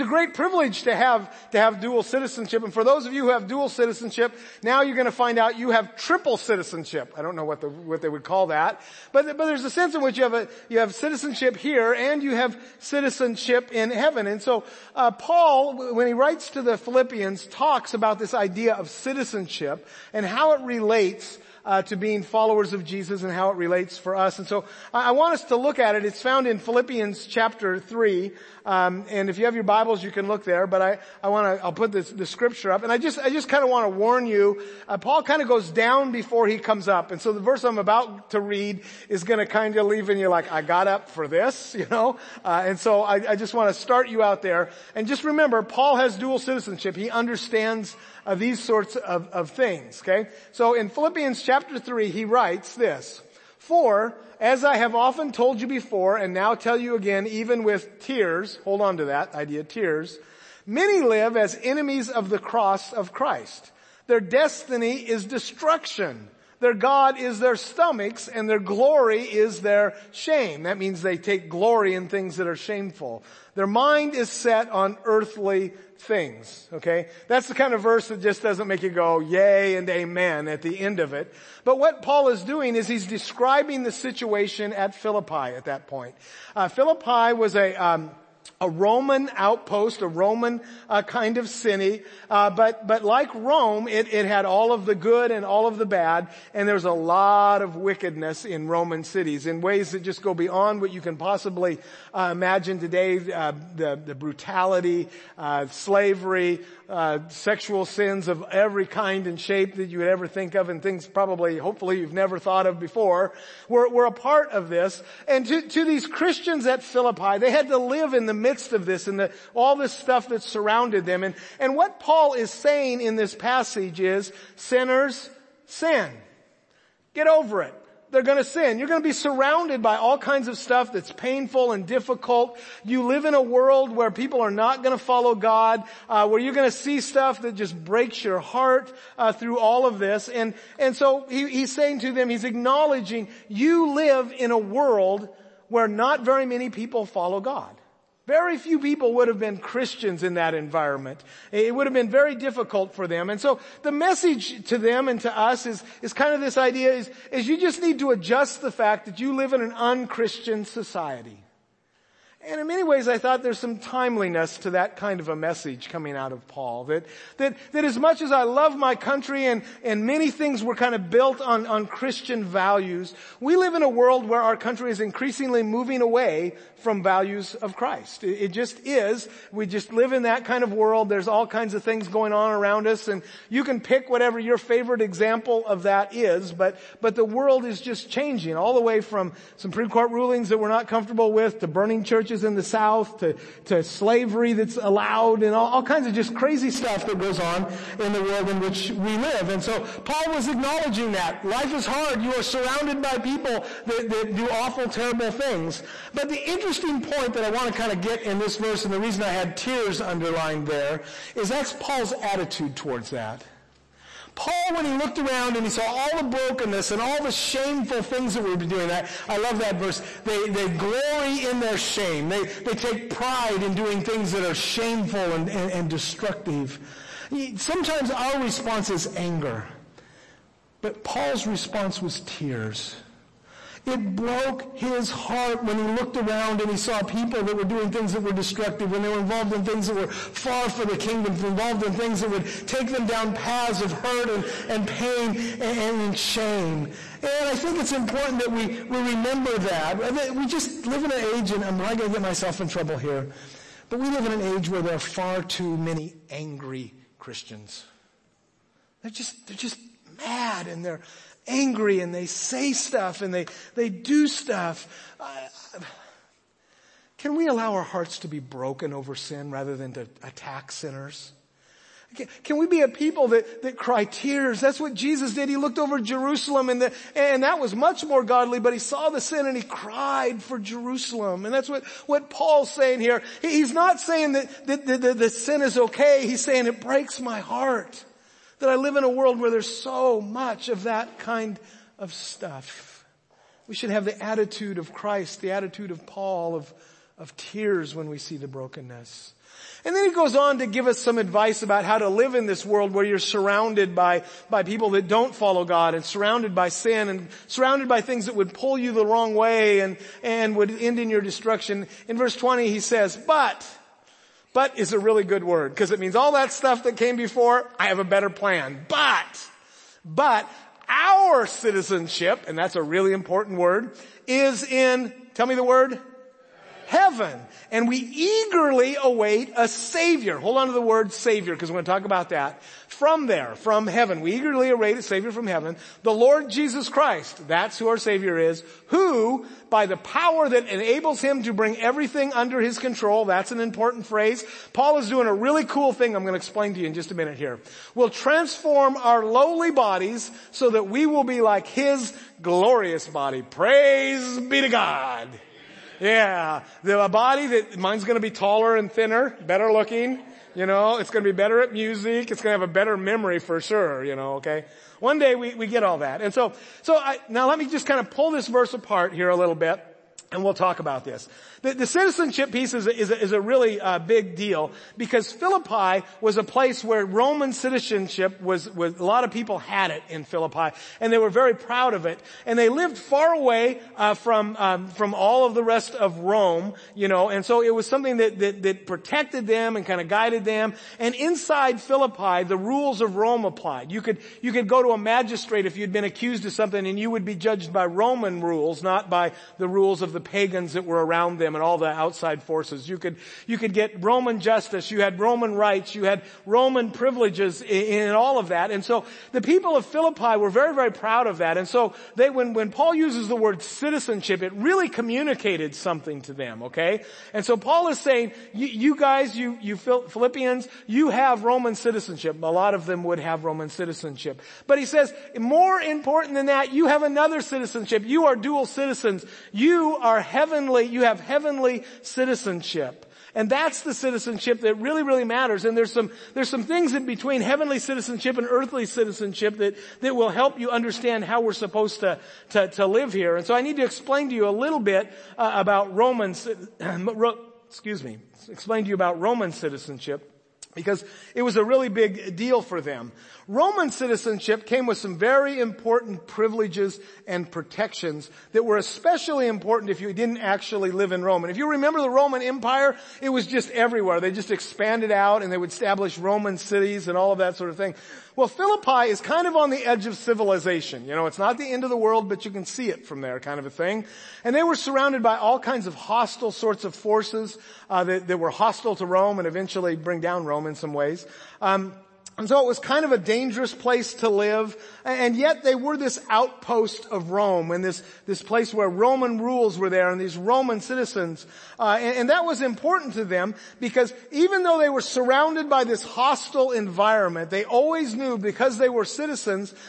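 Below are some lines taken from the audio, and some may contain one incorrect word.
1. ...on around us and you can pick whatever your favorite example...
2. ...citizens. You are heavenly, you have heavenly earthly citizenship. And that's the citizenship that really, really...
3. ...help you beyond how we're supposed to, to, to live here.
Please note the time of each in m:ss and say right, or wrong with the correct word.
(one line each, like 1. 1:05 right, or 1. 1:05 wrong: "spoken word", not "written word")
1. 3:02 right
2. 7:08 wrong: "heavenly", not "earthly"
3. 7:20 wrong: "understand", not "beyond".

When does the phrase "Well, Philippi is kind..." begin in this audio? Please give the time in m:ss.
7:48.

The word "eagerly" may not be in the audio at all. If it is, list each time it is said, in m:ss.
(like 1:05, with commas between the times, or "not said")
5:27, 5:34.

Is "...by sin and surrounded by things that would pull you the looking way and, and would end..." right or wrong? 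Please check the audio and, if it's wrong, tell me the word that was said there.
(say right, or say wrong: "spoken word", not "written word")
wrong: "wrong", not "looking".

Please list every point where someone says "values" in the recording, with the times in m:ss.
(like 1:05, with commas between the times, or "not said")
2:52, 2:57.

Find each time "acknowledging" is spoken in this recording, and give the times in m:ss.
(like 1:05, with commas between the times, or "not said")
2:22, 3:20.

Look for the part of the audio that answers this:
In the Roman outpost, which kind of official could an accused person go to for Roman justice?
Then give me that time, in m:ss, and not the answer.
6:34.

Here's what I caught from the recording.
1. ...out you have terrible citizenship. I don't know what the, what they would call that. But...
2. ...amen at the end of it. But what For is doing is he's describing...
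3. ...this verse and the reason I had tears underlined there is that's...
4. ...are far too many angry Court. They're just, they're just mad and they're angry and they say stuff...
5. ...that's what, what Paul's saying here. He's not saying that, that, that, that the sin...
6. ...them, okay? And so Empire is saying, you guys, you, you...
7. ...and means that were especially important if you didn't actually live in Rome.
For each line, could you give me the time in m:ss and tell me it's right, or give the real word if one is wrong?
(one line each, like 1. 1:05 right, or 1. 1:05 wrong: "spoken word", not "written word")
1. 0:05 wrong: "triple", not "terrible"
2. 1:19 wrong: "Paul", not "For"
3. 3:28 right
4. 4:14 wrong: "Christians", not "Court"
5. 4:41 right
6. 6:56 wrong: "Paul", not "Empire"
7. 7:37 wrong: "protections", not "means".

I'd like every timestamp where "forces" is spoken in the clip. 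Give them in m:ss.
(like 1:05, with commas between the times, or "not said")
6:42, 7:56.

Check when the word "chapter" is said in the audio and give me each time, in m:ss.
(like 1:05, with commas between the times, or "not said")
0:27, 0:51.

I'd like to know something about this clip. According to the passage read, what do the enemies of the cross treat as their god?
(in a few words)
Their stomachs.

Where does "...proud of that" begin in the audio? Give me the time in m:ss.
6:50.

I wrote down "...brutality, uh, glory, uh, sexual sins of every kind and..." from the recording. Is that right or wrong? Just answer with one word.
wrong.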